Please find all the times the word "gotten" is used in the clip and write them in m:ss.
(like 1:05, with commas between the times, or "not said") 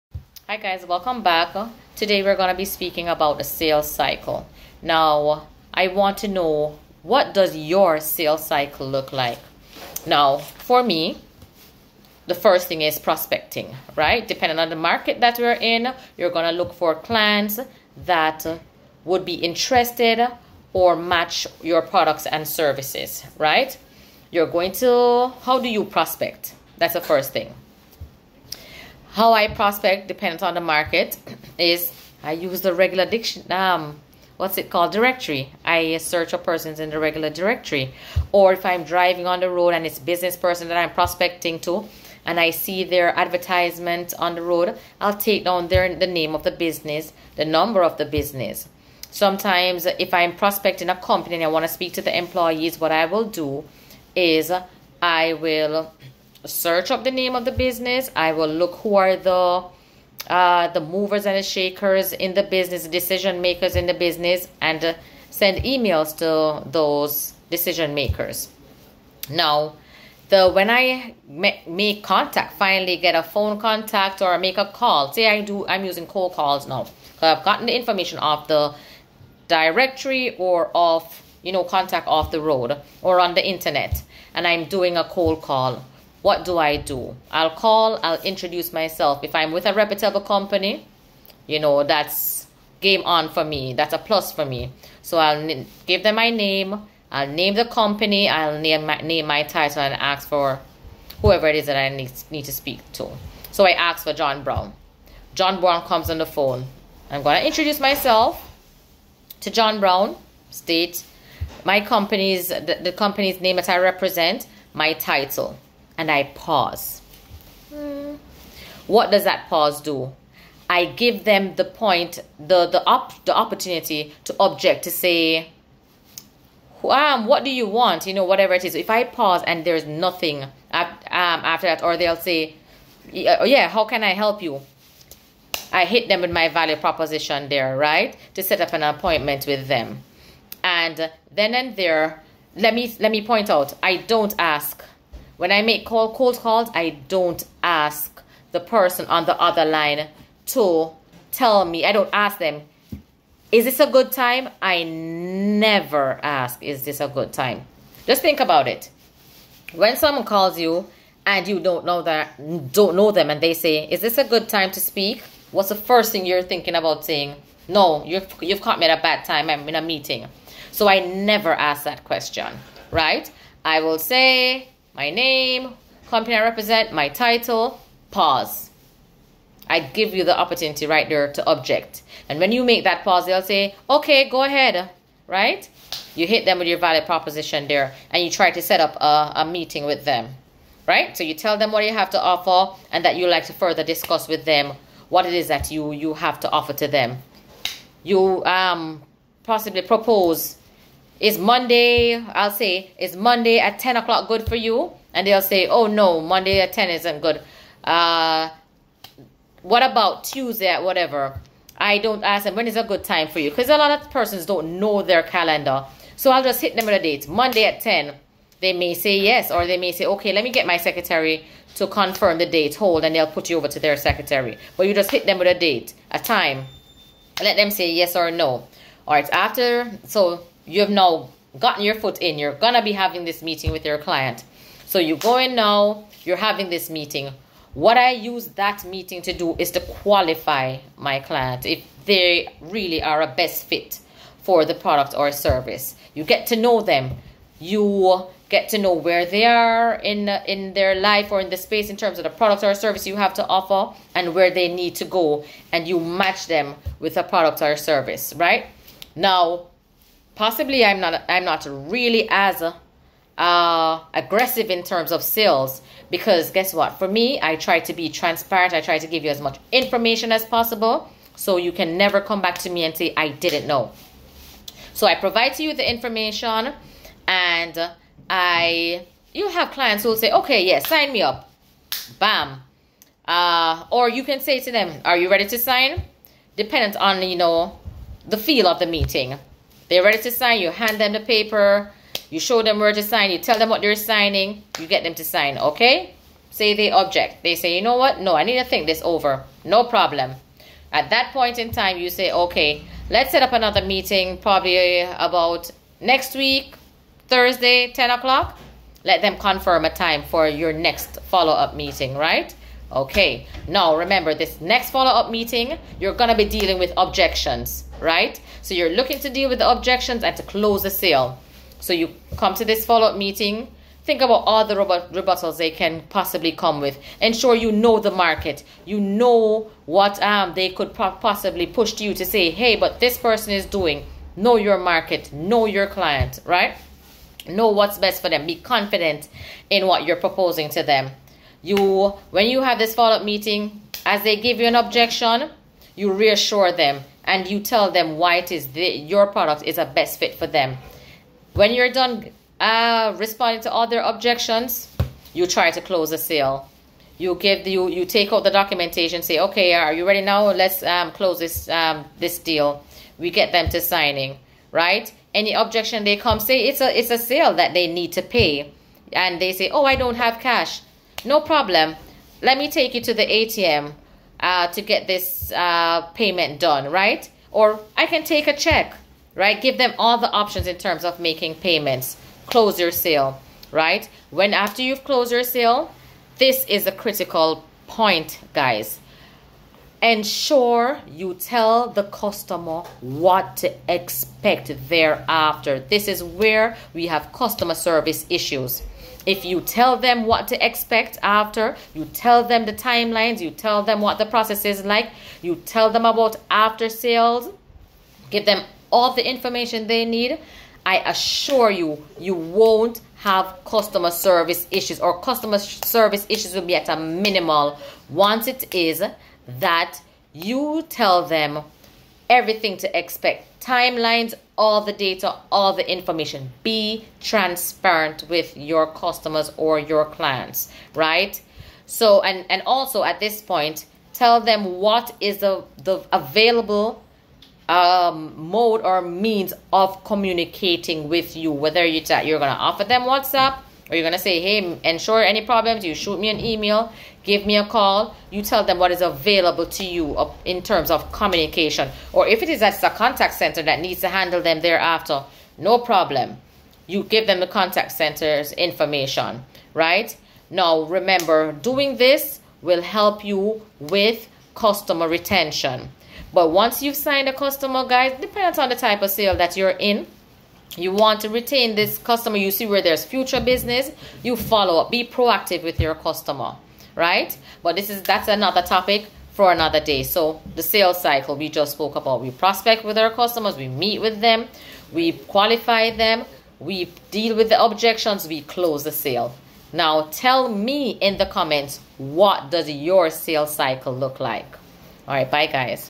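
1:17, 3:51.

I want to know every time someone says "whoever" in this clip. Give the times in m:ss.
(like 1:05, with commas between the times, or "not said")
1:41.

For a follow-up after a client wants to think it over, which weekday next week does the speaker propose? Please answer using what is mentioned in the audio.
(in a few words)
Thursday.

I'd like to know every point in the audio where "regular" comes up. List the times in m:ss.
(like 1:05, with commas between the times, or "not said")
0:32, 0:36.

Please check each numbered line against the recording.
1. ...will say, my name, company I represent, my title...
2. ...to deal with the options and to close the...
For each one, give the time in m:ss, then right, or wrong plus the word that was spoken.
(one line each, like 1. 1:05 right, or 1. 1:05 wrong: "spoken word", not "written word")
1. 2:53 right
2. 5:19 wrong: "objections", not "options".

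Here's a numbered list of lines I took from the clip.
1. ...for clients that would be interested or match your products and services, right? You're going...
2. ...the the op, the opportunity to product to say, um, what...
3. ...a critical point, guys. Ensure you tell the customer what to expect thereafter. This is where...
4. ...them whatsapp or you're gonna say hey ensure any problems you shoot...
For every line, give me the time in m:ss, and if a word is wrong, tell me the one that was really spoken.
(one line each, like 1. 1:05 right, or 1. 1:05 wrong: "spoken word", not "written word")
1. 0:16 right
2. 2:02 wrong: "object", not "product"
3. 6:26 right
4. 7:22 right.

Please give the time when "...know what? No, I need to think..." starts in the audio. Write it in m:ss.
4:57.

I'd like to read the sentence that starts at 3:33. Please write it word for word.
Because a lot of persons don't know their calendar.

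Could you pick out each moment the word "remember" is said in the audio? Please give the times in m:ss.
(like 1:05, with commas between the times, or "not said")
5:13, 7:40.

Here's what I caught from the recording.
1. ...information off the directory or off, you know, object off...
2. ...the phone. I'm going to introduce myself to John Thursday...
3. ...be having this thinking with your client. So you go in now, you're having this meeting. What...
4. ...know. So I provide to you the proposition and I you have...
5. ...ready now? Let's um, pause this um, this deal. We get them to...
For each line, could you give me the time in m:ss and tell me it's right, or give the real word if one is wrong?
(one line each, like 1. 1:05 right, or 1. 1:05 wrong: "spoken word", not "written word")
1. 1:17 wrong: "contact", not "object"
2. 1:46 wrong: "Brown", not "Thursday"
3. 3:52 wrong: "meeting", not "thinking"
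4. 4:33 wrong: "information", not "proposition"
5. 6:00 wrong: "close", not "pause".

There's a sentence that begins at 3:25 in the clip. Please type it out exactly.
And they'll say, oh no, Monday at 10 isn't good.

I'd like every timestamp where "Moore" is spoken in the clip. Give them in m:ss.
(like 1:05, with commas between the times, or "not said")
not said.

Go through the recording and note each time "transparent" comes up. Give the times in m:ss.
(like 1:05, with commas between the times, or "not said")
4:28, 7:07.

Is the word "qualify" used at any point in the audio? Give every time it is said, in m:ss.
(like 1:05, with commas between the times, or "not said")
3:59, 8:05.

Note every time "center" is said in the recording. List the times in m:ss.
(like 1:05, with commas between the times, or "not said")
7:33, 7:37.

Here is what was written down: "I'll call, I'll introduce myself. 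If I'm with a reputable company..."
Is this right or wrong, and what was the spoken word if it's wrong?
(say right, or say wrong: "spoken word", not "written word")
right.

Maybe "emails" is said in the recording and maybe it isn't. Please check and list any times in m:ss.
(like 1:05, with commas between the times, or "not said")
1:05, 7:26.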